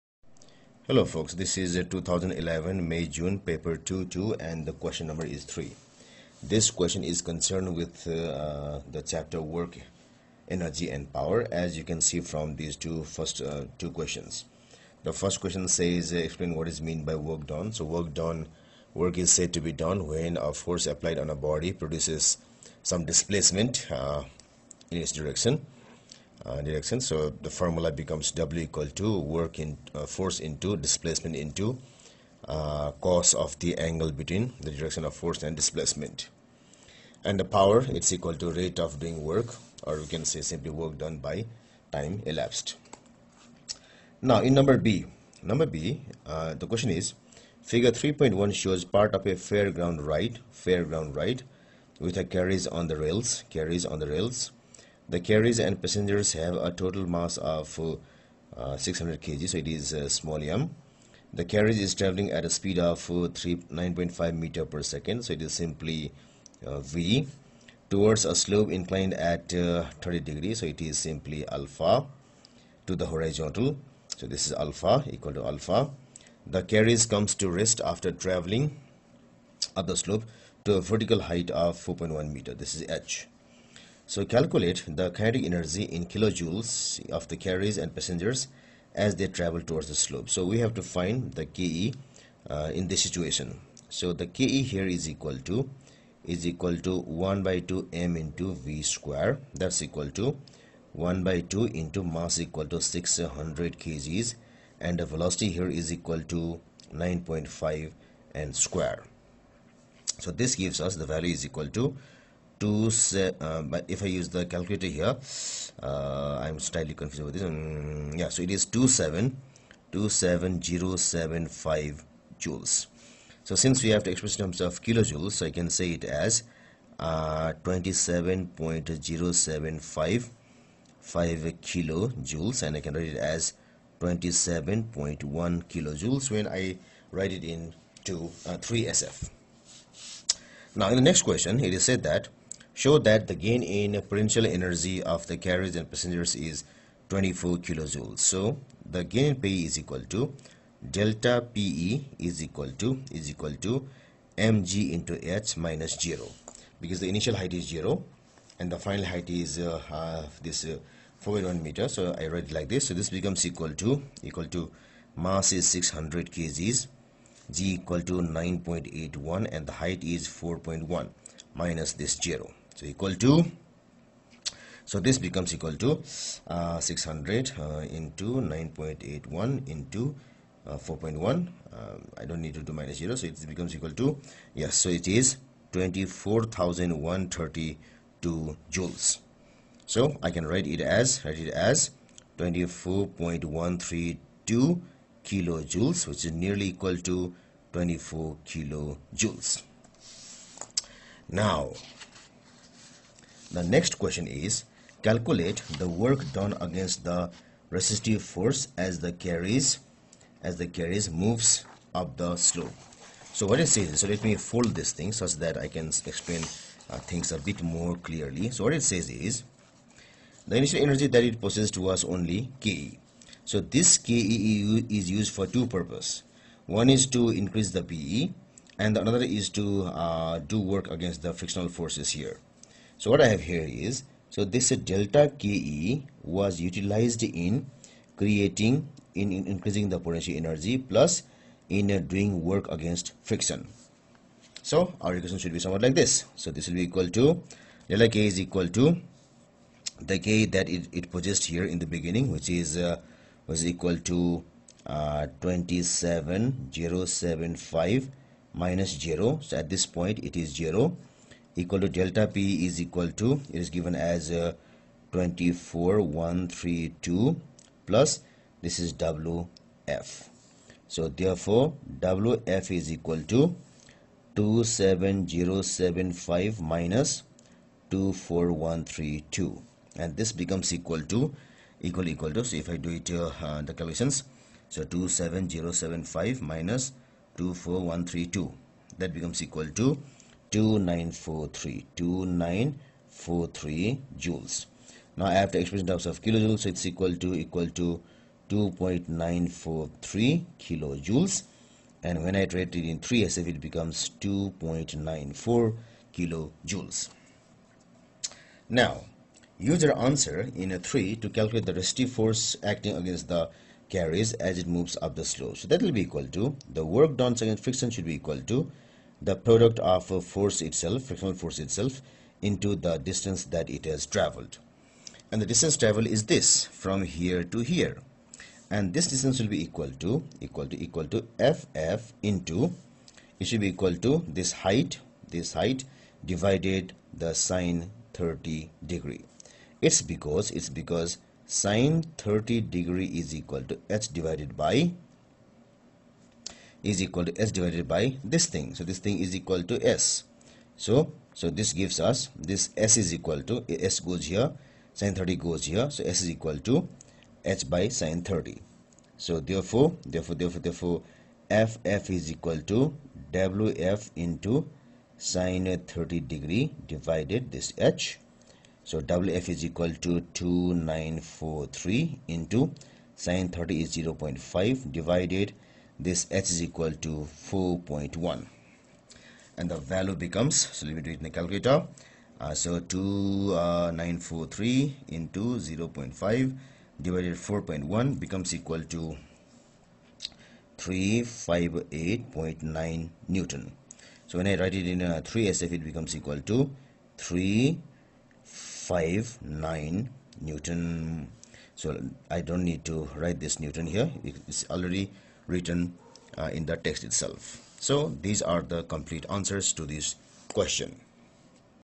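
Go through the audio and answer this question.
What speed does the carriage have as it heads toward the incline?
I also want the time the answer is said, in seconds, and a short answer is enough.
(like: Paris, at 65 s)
9.5 m/s, at 63 s.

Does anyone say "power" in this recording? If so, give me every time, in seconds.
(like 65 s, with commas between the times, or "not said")
11 s, 37 s.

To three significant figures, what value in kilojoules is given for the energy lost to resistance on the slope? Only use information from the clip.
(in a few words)
2.94 kJ.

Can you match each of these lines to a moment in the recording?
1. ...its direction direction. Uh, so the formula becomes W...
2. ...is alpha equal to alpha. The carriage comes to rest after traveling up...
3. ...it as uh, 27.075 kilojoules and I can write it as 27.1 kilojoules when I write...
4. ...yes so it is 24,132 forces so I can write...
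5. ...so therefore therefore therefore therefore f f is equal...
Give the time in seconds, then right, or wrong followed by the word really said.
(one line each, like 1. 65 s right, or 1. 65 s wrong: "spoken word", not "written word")
1. 24 s right
2. 74 s right
3. 125 s right
4. 184 s wrong: "joules", not "forces"
5. 359 s right.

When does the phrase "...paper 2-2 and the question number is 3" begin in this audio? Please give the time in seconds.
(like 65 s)
3 s.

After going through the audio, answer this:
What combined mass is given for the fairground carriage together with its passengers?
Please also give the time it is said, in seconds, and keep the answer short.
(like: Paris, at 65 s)
600 kg, at 58 s.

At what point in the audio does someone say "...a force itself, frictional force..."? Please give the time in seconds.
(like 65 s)
320 s.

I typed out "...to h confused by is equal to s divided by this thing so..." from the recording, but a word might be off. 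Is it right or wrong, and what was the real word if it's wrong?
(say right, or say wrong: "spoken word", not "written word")
wrong: "divided", not "confused".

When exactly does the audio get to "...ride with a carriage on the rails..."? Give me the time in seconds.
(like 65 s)
51 s.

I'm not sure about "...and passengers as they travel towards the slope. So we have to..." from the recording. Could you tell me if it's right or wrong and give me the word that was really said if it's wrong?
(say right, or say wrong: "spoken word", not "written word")
right.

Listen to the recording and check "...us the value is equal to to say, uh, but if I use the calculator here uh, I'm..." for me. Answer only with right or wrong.
right.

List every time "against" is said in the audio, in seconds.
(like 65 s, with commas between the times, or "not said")
206 s, 230 s, 242 s, 312 s, 317 s.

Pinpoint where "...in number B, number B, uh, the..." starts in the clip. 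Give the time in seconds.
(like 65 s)
44 s.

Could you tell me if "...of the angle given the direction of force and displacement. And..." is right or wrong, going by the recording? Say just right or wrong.
wrong.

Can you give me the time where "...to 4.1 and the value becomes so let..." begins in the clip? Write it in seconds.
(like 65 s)
376 s.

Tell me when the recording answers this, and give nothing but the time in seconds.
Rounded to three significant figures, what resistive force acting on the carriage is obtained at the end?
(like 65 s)
397 s.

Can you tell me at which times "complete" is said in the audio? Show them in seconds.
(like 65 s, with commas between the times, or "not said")
408 s.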